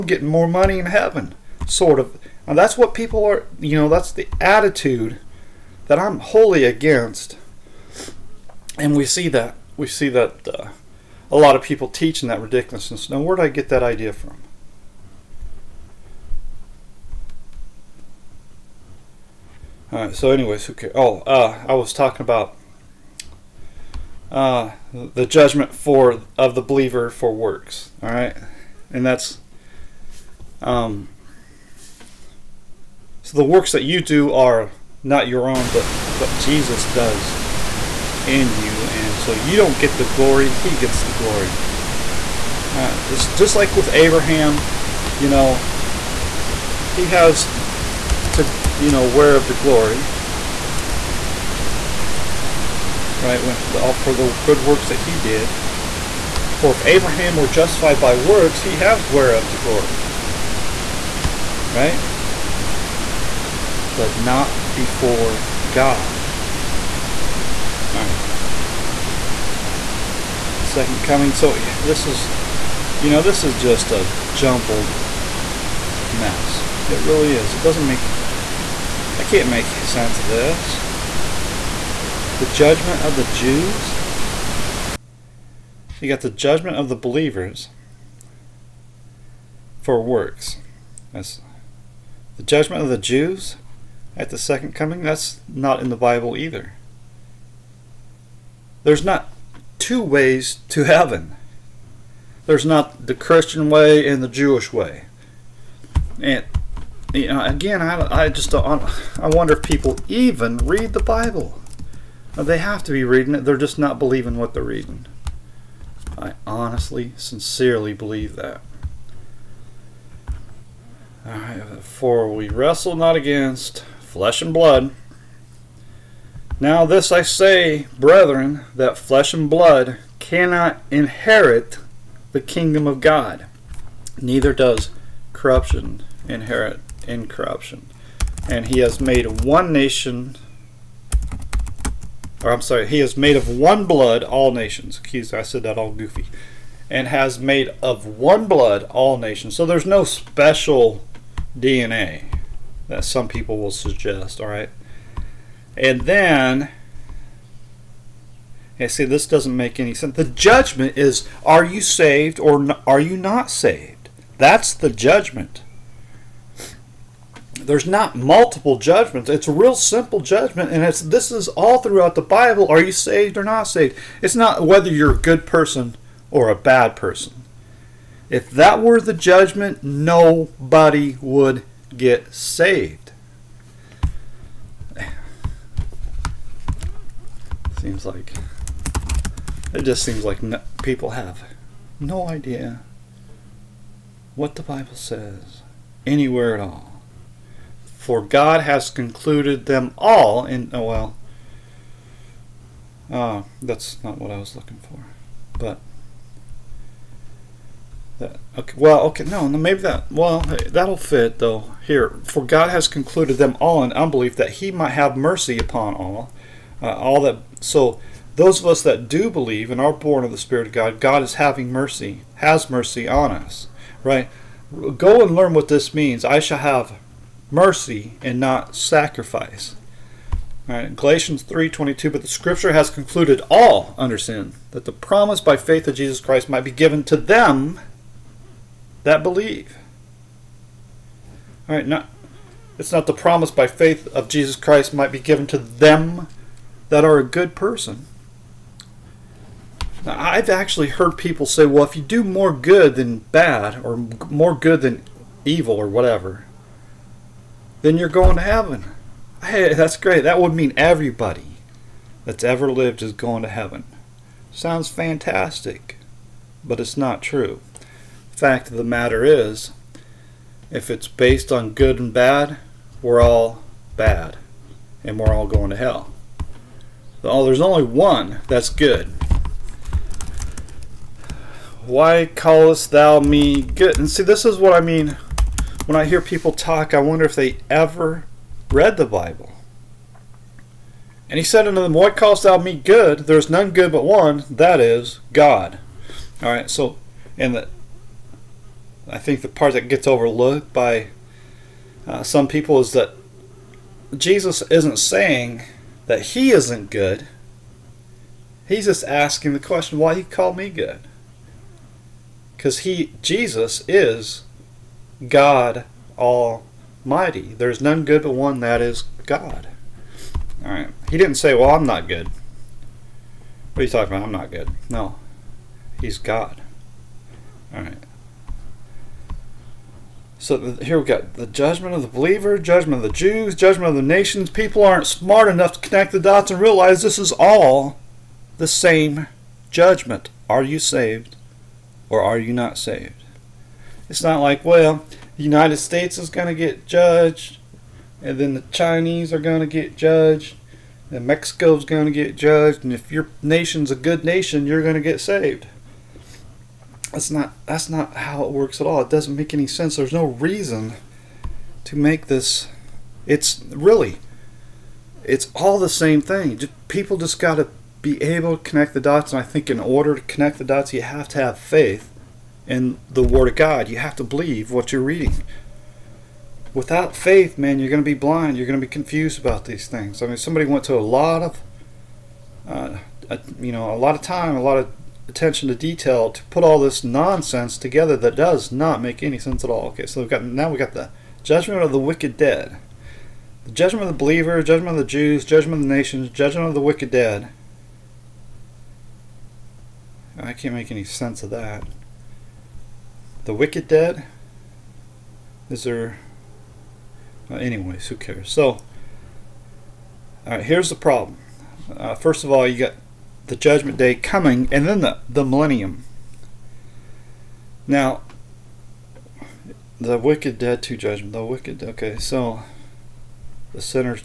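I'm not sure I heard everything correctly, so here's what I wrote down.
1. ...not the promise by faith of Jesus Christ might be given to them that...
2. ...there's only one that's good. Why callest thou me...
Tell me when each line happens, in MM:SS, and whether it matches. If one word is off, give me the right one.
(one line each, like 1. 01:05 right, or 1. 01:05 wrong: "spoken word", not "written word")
1. 04:02 right
2. 04:37 right.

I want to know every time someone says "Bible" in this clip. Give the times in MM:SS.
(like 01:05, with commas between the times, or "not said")
01:35, 01:51, 02:52, 03:14, 04:49.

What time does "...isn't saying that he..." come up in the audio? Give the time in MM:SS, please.
05:04.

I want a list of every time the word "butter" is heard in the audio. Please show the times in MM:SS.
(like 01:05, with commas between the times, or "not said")
not said.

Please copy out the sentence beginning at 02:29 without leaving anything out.
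So there's no special DNA that some people will suggest, all right?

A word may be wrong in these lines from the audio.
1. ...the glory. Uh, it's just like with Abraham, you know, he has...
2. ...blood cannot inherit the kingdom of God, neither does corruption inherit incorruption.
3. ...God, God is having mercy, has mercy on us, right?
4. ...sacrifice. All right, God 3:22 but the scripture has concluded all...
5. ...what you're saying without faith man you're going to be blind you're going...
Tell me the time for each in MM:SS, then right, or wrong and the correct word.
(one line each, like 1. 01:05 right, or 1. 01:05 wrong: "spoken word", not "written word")
1. 00:41 right
2. 02:09 right
3. 03:40 right
4. 03:48 wrong: "Galatians", not "God"
5. 06:14 wrong: "reading", not "saying".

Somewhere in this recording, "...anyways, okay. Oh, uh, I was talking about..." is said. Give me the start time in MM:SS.
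00:20.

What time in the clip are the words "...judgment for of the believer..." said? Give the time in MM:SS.
00:25.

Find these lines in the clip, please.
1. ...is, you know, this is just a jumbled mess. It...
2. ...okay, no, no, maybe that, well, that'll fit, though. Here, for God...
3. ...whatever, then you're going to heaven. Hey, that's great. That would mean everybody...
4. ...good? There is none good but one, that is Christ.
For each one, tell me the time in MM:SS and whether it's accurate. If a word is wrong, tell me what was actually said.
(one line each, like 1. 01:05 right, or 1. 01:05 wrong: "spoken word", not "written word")
1. 01:12 right
2. 03:29 right
3. 04:15 right
4. 04:52 wrong: "God", not "Christ".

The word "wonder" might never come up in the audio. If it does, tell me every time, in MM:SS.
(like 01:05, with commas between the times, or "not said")
01:49, 04:47.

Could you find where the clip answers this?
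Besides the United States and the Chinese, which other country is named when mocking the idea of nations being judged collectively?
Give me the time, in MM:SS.
05:51.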